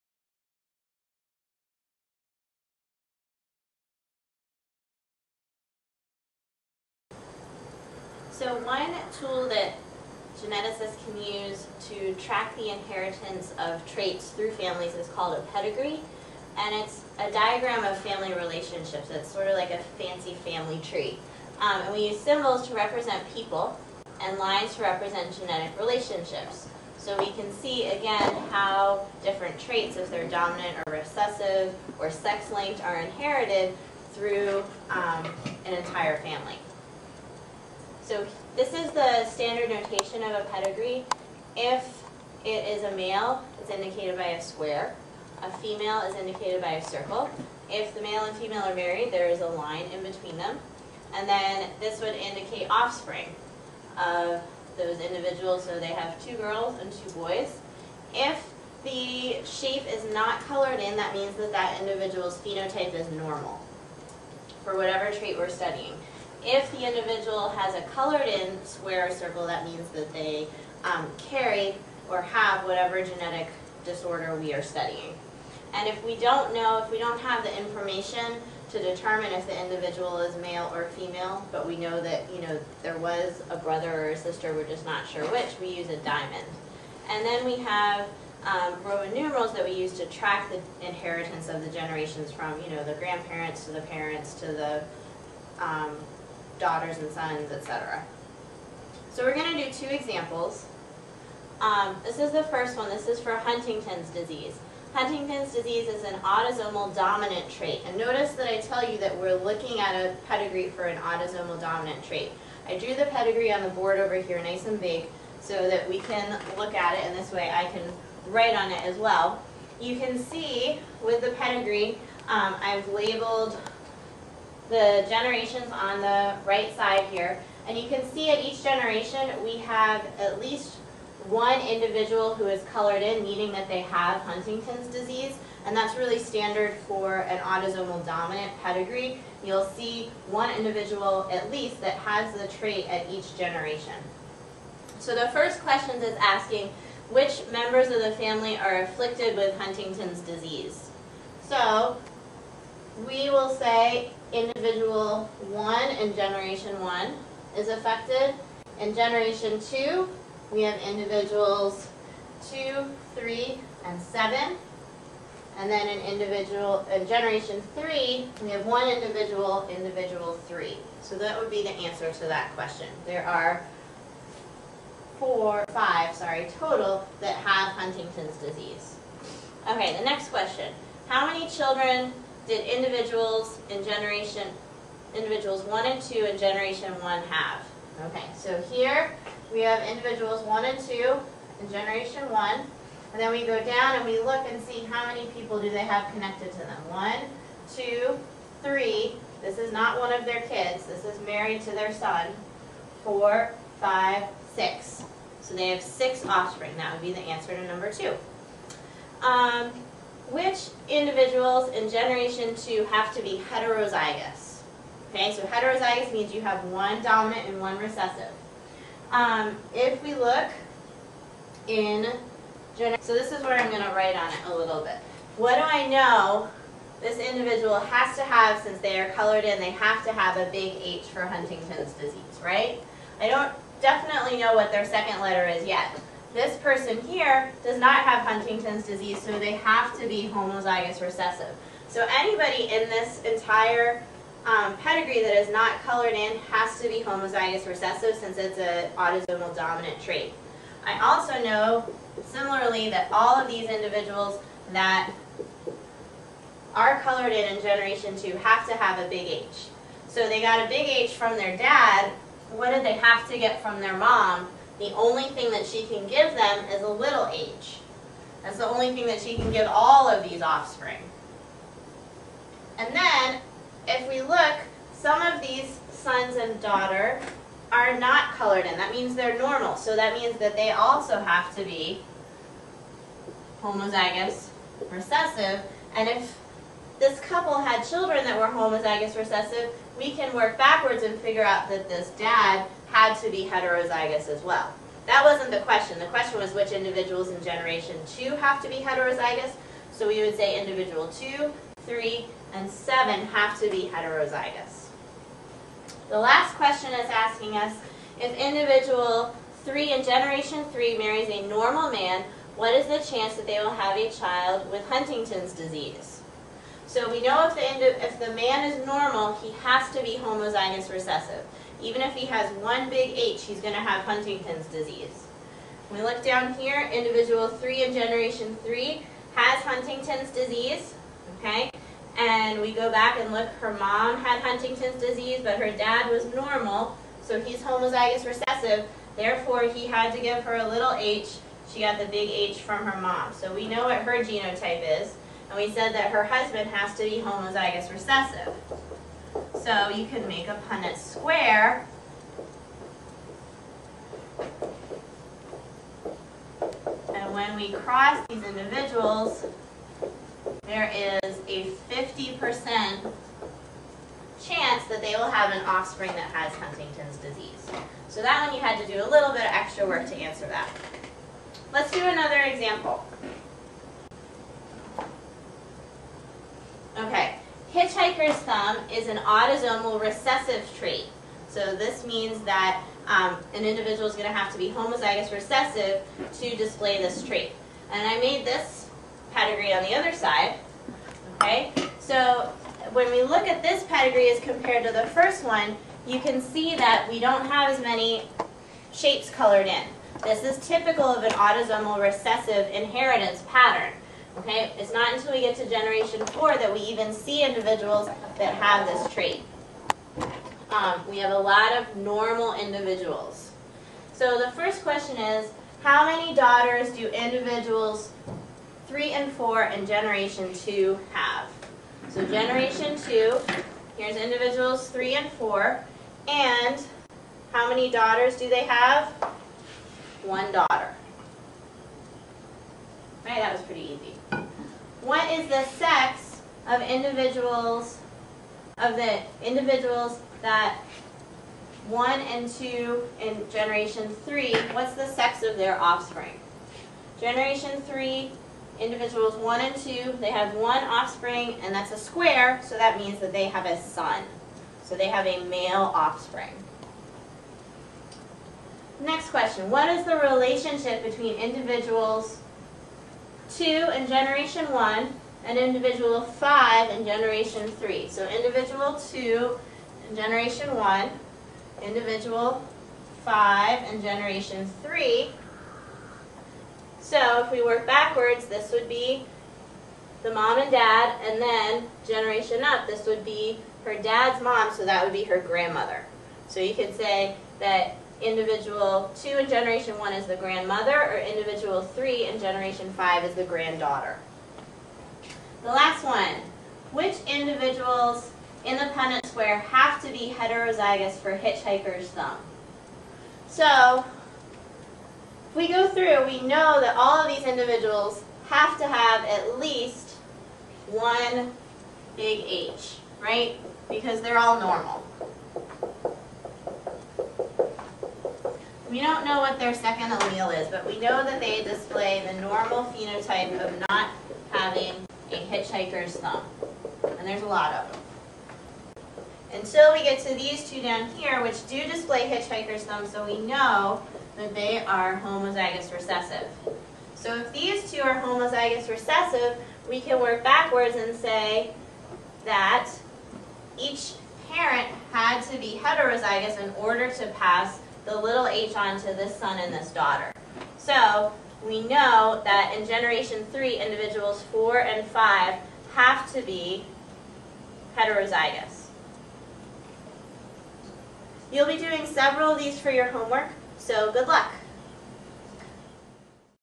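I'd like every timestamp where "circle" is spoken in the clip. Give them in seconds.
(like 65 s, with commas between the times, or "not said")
46 s, 69 s.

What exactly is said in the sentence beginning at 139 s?
You'll see one individual at least that has the trait at each generation.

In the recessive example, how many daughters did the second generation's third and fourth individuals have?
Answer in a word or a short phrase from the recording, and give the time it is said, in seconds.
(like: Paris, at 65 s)
1, at 430 s.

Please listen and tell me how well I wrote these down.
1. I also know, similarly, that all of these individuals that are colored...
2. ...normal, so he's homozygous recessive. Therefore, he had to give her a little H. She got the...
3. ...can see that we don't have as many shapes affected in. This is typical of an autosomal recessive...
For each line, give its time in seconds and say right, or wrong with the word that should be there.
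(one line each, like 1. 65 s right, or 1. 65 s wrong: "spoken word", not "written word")
1. 250 s right
2. 336 s right
3. 396 s wrong: "colored", not "affected".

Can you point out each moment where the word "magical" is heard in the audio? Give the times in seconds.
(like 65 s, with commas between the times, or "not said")
not said.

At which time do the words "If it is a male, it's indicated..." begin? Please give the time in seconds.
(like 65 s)
41 s.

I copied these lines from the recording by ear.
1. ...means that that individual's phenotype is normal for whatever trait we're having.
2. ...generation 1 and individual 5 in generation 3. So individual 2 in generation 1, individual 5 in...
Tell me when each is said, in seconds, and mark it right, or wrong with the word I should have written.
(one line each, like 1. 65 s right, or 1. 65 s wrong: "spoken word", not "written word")
1. 61 s wrong: "studying", not "having"
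2. 464 s right.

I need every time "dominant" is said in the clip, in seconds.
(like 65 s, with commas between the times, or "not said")
30 s, 106 s, 111 s, 138 s, 217 s, 249 s.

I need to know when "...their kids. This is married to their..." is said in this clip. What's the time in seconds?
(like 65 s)
200 s.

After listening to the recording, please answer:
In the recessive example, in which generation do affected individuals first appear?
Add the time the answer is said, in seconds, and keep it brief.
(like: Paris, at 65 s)
Generation four, at 405 s.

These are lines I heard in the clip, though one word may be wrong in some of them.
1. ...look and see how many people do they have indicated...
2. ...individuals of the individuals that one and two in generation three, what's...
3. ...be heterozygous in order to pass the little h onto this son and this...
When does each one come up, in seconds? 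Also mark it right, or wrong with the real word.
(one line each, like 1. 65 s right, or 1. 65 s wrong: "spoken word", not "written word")
1. 194 s wrong: "connected", not "indicated"
2. 436 s right
3. 545 s right.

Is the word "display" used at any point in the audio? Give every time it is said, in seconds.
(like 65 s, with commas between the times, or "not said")
386 s, 521 s, 531 s.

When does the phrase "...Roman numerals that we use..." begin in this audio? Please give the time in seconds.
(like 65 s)
88 s.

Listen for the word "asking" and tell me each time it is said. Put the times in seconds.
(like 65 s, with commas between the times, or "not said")
146 s, 307 s.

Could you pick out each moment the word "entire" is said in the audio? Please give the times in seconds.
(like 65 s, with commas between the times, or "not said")
35 s, 243 s.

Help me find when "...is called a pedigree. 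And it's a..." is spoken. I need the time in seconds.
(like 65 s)
14 s.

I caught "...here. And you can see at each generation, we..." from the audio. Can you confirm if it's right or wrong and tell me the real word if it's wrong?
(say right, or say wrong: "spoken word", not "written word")
right.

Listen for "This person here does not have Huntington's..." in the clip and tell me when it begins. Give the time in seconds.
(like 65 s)
236 s.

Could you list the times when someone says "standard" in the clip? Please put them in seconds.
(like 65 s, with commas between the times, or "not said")
39 s, 136 s.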